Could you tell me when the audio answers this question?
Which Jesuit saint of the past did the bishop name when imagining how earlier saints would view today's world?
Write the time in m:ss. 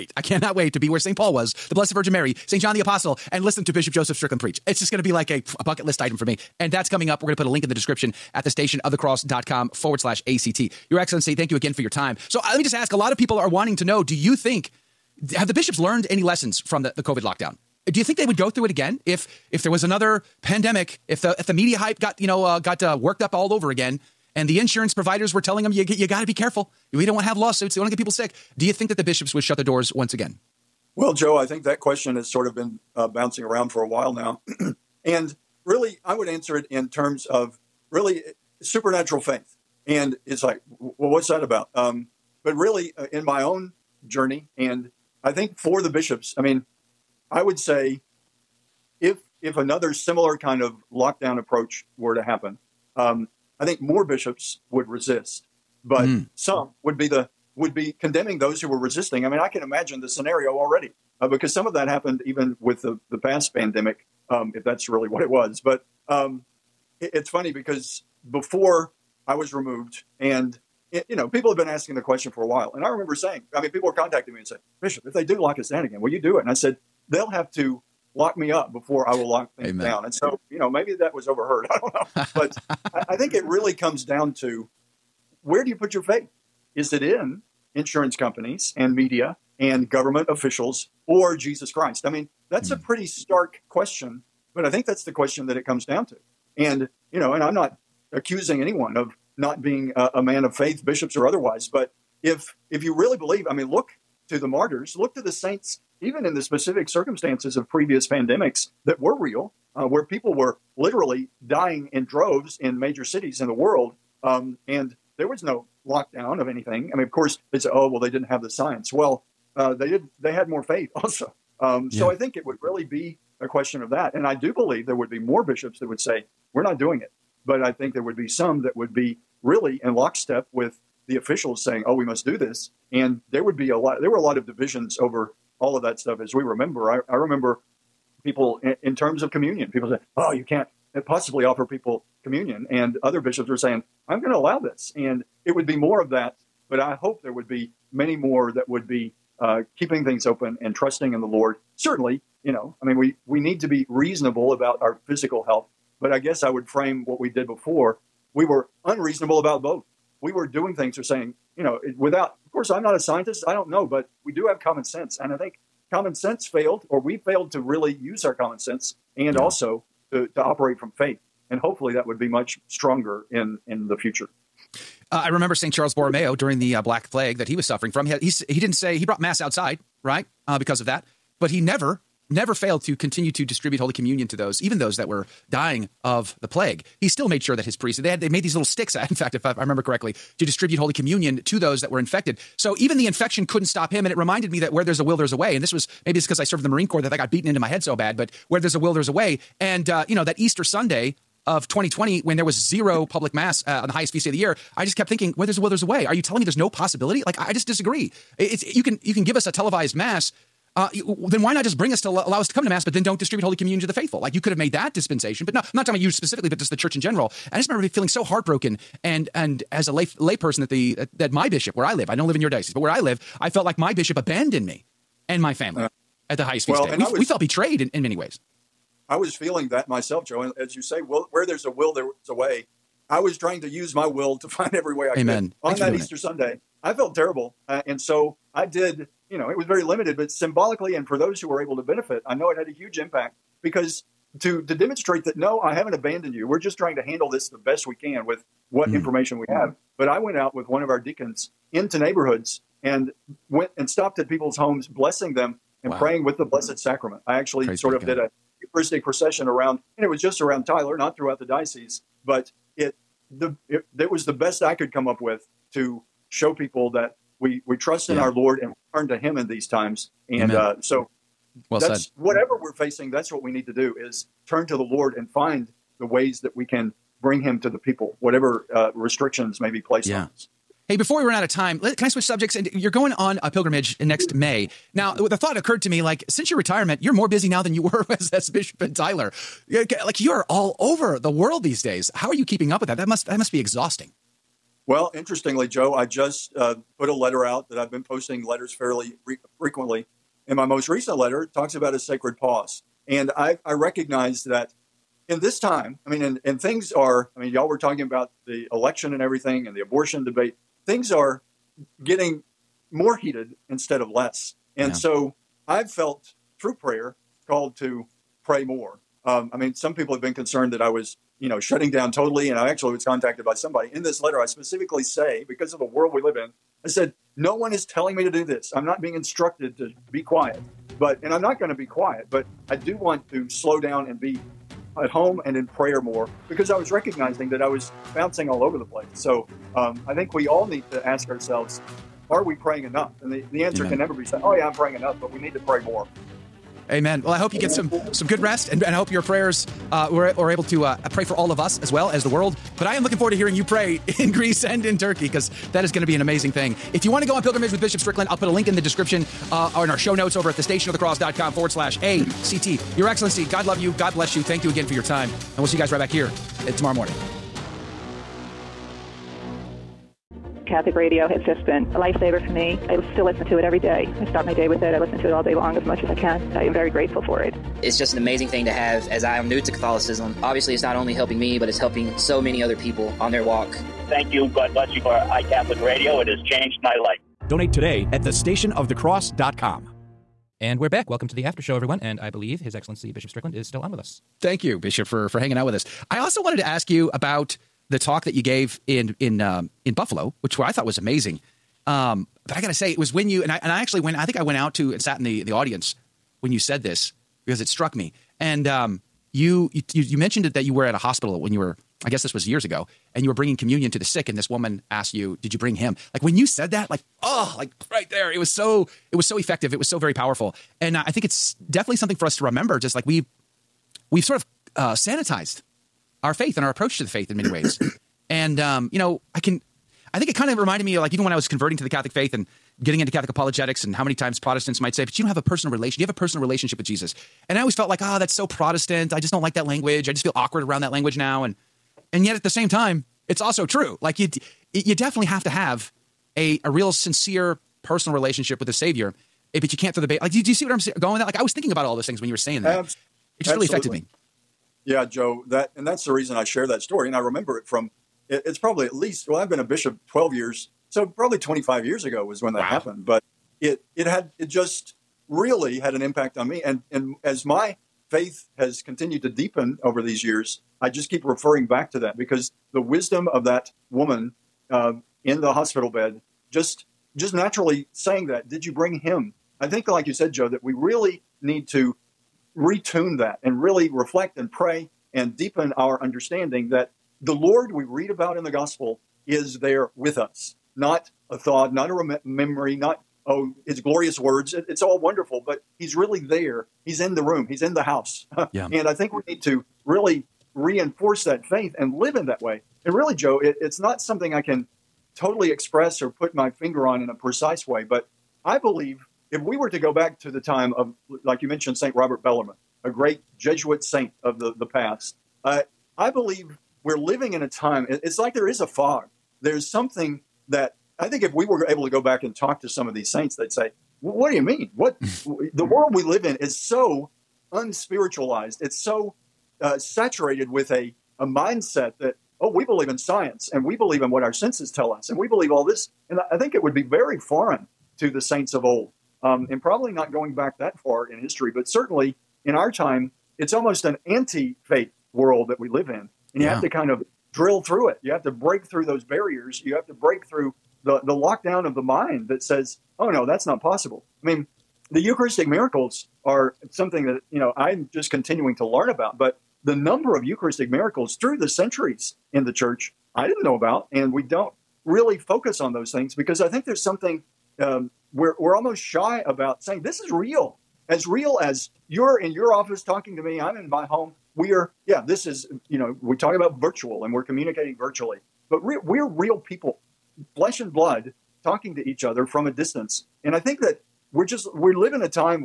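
8:31.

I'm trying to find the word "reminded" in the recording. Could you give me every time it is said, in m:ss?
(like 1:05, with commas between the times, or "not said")
3:14, 7:10.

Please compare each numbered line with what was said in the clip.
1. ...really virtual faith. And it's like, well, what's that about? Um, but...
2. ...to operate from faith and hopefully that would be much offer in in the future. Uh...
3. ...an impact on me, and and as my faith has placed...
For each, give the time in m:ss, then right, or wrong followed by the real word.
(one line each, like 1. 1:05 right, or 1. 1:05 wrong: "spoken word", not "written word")
1. 0:37 wrong: "supernatural", not "virtual"
2. 2:50 wrong: "stronger", not "offer"
3. 7:45 wrong: "continued", not "placed".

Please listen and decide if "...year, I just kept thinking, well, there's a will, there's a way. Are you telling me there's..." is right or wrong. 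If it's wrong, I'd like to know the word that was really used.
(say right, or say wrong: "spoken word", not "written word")
right.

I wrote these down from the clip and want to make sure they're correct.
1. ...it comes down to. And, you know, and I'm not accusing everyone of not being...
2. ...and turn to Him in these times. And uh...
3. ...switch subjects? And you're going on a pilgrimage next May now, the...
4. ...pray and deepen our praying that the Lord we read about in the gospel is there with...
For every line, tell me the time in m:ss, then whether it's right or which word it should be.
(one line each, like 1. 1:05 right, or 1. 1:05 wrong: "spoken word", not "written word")
1. 1:35 wrong: "anyone", not "everyone"
2. 4:28 right
3. 4:42 right
4. 8:04 wrong: "understanding", not "praying".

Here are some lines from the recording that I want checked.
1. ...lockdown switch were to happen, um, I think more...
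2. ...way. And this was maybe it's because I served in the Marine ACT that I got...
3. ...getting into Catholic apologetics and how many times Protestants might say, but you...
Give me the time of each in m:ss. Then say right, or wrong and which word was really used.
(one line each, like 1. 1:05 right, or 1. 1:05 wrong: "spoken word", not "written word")
1. 0:50 wrong: "approach", not "switch"
2. 3:15 wrong: "Corps", not "ACT"
3. 7:12 right.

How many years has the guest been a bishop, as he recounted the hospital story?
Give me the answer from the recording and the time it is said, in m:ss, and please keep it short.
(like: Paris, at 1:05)
12, at 7:40.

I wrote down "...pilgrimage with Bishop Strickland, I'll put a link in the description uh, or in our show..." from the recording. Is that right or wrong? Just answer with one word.
right.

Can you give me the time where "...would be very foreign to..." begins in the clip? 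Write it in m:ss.
8:56.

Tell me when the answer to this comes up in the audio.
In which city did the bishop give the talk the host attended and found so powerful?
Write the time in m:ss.
6:39.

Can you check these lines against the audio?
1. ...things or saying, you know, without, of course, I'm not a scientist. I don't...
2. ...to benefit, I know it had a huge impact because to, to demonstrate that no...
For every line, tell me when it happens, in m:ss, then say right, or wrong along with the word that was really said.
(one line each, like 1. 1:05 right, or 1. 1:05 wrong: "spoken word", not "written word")
1. 2:40 right
2. 4:01 right.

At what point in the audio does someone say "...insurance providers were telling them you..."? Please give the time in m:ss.
0:24.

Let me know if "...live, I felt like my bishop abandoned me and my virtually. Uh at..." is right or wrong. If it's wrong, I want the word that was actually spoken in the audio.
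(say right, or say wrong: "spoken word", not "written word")
wrong: "family", not "virtually".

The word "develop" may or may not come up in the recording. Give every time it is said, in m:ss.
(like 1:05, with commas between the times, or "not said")
not said.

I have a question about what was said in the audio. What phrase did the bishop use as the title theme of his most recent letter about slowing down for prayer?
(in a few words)
sacred pause.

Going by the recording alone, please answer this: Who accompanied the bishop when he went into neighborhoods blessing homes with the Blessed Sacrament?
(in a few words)
one of our deacons.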